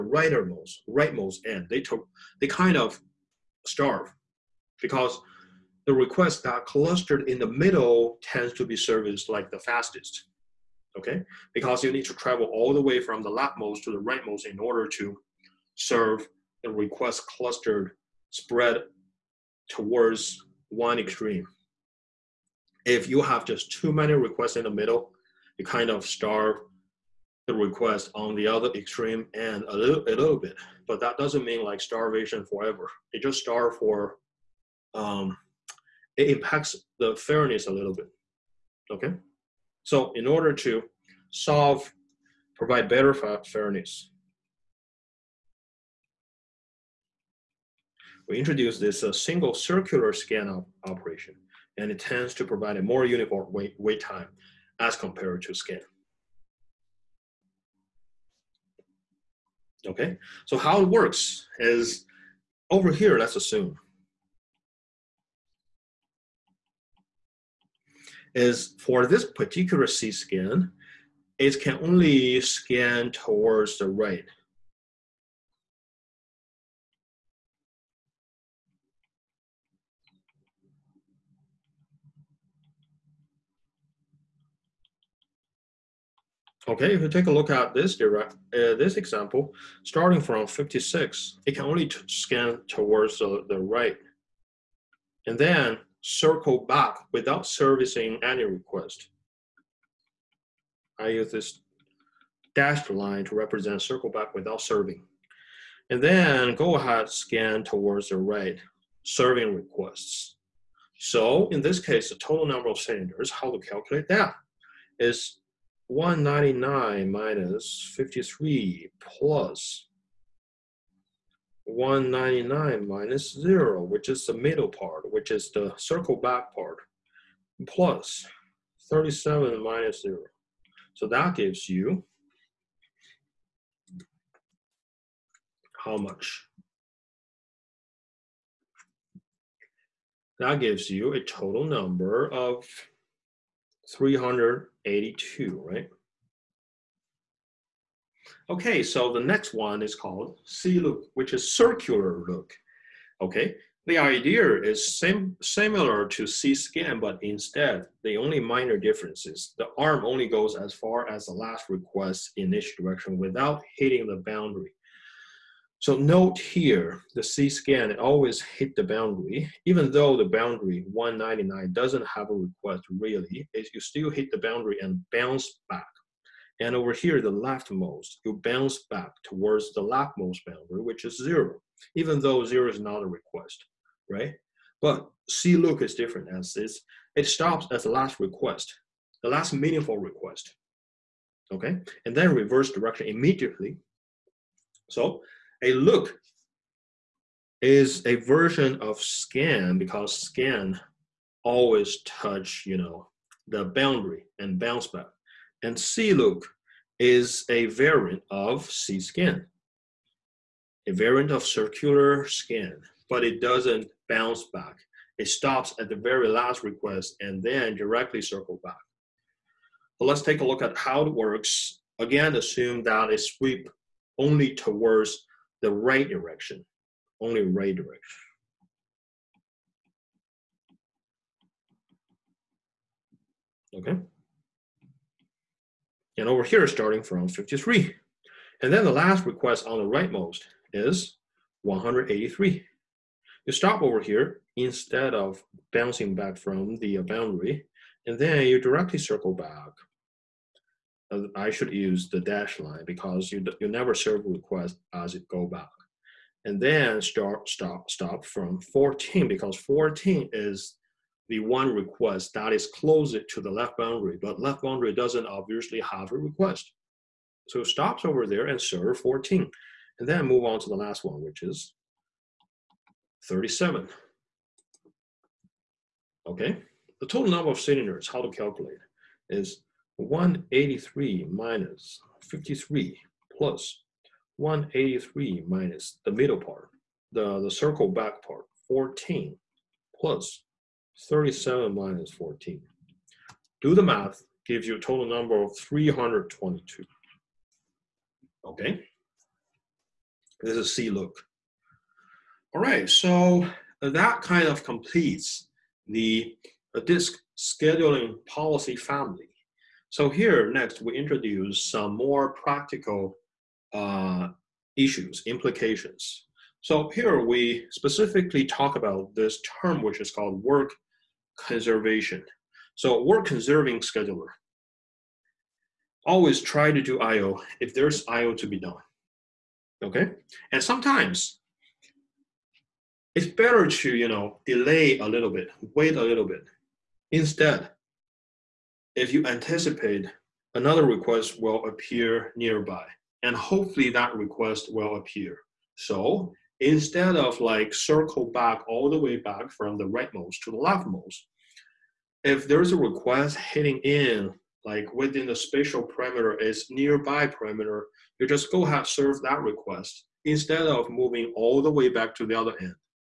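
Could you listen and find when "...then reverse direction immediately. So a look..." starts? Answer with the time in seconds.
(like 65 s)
192 s.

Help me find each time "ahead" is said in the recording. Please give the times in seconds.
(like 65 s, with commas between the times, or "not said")
106 s, 358 s.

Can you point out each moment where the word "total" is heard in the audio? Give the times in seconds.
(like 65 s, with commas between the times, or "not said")
112 s, 141 s, 277 s, 294 s.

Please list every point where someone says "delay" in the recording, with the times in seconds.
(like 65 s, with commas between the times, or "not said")
334 s.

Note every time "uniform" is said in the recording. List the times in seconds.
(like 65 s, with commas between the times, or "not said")
53 s.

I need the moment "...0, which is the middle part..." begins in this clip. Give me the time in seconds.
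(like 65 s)
123 s.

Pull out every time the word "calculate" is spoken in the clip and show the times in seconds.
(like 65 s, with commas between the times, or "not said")
113 s, 278 s.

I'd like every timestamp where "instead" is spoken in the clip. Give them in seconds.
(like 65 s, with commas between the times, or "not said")
157 s, 244 s, 337 s, 346 s, 360 s.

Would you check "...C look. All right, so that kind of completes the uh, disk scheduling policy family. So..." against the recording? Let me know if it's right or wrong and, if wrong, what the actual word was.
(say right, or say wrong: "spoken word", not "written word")
right.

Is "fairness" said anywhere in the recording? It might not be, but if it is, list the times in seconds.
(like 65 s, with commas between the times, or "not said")
37 s, 43 s.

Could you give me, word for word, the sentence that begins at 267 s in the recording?
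So stops over there and serve 14.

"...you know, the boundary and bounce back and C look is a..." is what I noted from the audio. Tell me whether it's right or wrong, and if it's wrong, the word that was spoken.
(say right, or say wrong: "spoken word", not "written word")
right.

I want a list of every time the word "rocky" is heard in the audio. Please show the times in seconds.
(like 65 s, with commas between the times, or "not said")
not said.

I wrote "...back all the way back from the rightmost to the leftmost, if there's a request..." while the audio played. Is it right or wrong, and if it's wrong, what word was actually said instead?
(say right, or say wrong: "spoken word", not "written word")
right.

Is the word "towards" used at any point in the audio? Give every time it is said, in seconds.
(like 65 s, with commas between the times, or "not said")
19 s, 73 s, 92 s, 107 s, 179 s, 224 s.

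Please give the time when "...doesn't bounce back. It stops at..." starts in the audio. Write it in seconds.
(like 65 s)
213 s.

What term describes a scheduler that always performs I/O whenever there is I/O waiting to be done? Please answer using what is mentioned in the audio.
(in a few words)
work conservation.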